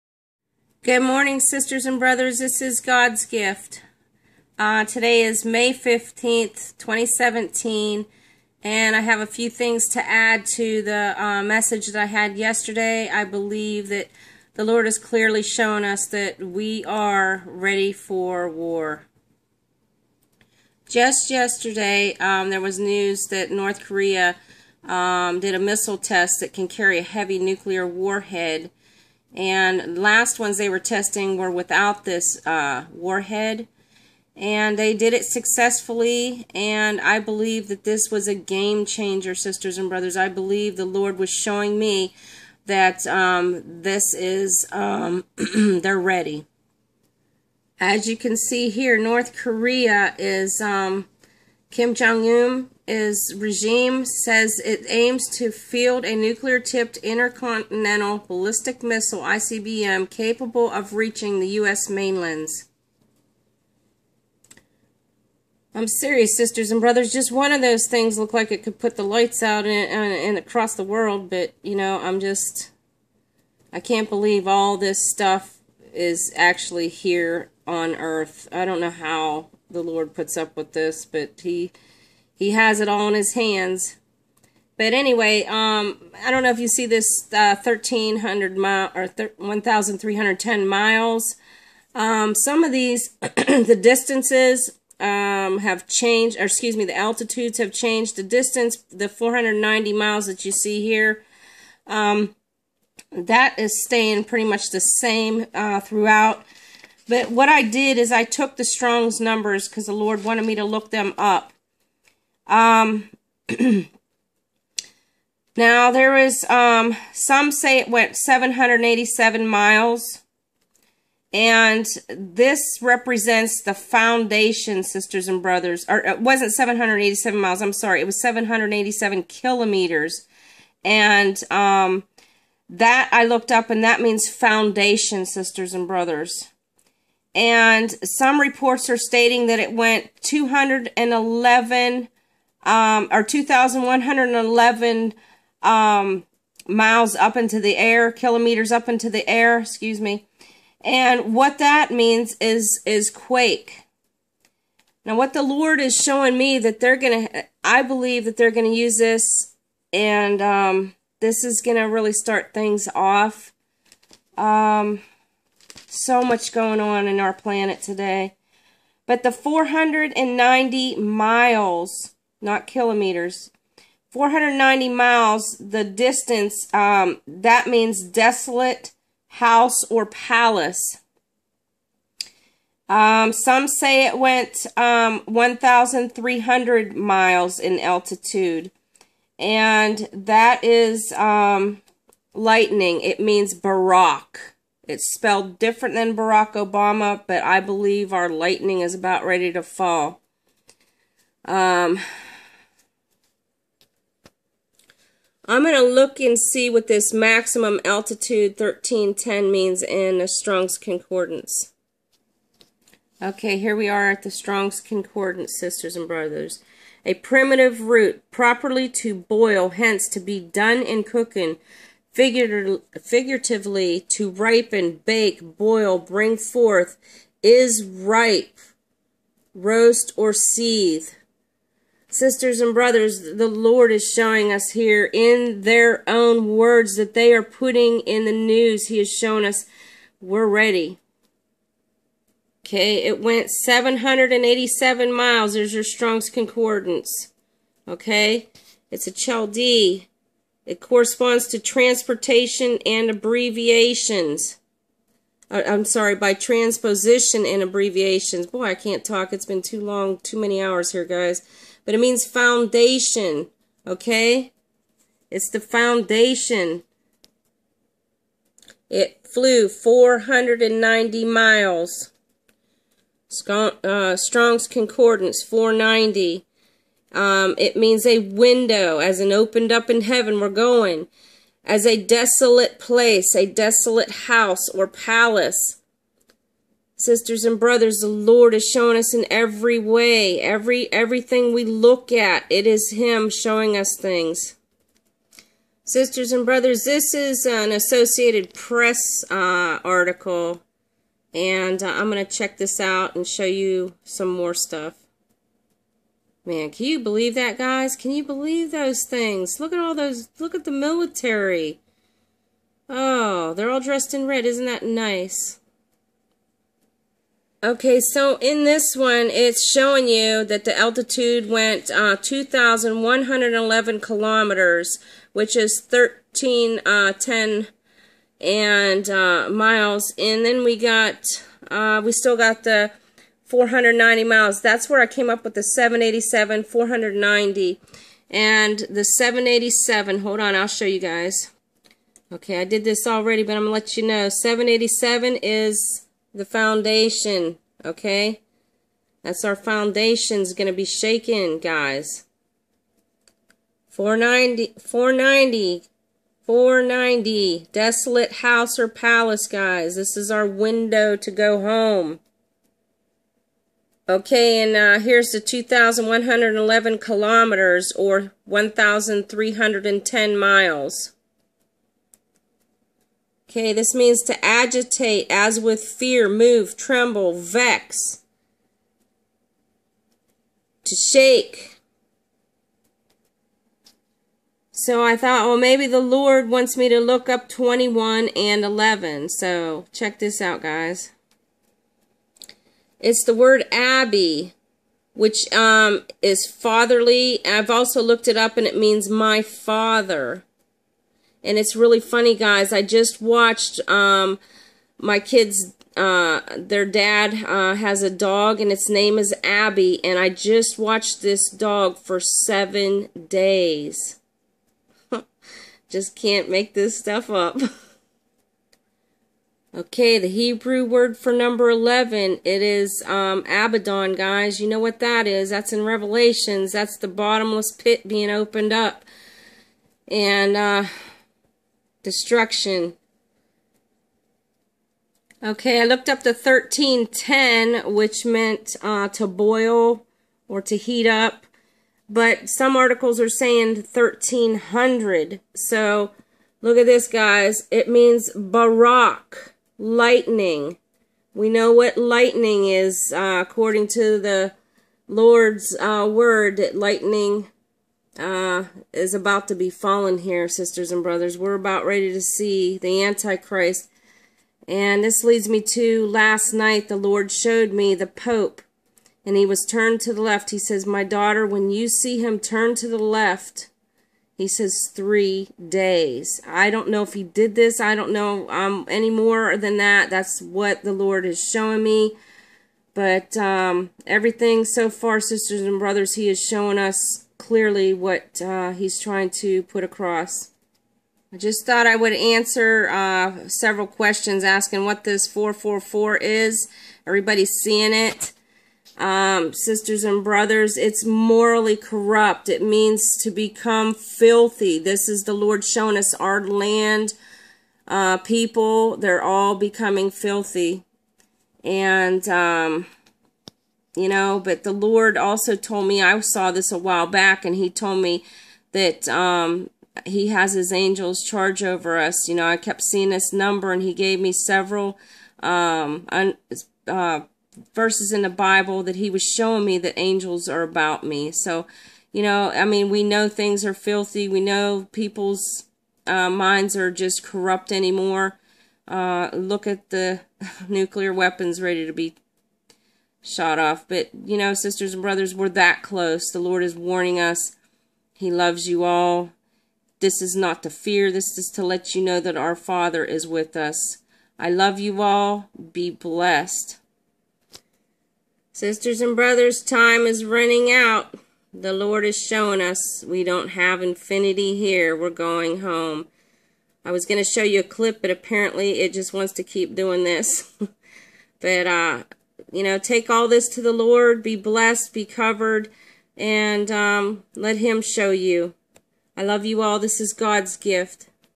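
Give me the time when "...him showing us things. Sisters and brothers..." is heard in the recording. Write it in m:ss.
4:52.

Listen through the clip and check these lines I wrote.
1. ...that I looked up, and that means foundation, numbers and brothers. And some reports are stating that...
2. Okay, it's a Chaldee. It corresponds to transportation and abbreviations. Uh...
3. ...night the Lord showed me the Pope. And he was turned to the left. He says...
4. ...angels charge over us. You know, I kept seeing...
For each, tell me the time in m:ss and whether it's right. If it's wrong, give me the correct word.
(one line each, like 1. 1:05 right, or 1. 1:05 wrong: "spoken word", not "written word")
1. 2:12 wrong: "sisters", not "numbers"
2. 4:07 right
3. 7:46 right
4. 8:40 right.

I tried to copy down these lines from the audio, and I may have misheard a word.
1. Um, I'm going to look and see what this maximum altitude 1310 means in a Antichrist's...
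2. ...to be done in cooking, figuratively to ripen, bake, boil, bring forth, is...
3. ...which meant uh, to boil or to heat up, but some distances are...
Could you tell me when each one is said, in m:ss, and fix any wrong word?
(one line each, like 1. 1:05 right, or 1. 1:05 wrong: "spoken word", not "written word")
1. 3:21 wrong: "Strong", not "Antichrist"
2. 3:40 right
3. 7:17 wrong: "articles", not "distances".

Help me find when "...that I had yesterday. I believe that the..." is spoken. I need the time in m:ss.
0:11.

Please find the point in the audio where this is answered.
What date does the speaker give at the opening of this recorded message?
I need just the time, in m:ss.
0:05.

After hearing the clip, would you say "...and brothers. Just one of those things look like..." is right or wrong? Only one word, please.
right.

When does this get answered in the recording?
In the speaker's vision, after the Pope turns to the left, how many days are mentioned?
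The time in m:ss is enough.
7:54.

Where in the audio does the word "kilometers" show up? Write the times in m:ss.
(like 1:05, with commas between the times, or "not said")
2:09, 2:28, 2:52, 5:23, 6:06.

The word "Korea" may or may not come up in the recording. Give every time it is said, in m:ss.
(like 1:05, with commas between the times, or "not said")
0:23, 0:49.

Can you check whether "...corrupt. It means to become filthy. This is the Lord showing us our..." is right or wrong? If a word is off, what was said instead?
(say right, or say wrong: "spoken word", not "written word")
right.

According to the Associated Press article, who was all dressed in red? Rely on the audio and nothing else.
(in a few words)
the military.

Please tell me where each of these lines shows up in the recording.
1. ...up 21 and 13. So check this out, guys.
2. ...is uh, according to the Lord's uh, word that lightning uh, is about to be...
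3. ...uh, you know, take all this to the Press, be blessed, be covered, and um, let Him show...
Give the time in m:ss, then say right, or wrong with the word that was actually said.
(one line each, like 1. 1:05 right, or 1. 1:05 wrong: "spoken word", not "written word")
1. 6:27 wrong: "11", not "13"
2. 7:32 right
3. 9:31 wrong: "Lord", not "Press".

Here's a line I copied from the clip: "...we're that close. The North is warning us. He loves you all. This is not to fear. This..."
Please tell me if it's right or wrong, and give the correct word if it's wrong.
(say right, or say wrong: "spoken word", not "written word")
wrong: "Lord", not "North".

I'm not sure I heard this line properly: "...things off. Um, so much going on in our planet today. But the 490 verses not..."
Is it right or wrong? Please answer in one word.
wrong.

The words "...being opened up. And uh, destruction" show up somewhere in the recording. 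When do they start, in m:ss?
7:08.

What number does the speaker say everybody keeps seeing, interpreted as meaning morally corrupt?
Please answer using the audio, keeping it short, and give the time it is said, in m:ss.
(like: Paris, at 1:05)
444, at 8:15.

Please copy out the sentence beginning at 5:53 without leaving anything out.
490, 490, 490, desolate house or palace, guys.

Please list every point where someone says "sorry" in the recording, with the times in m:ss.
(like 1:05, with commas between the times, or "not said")
2:07, 4:15.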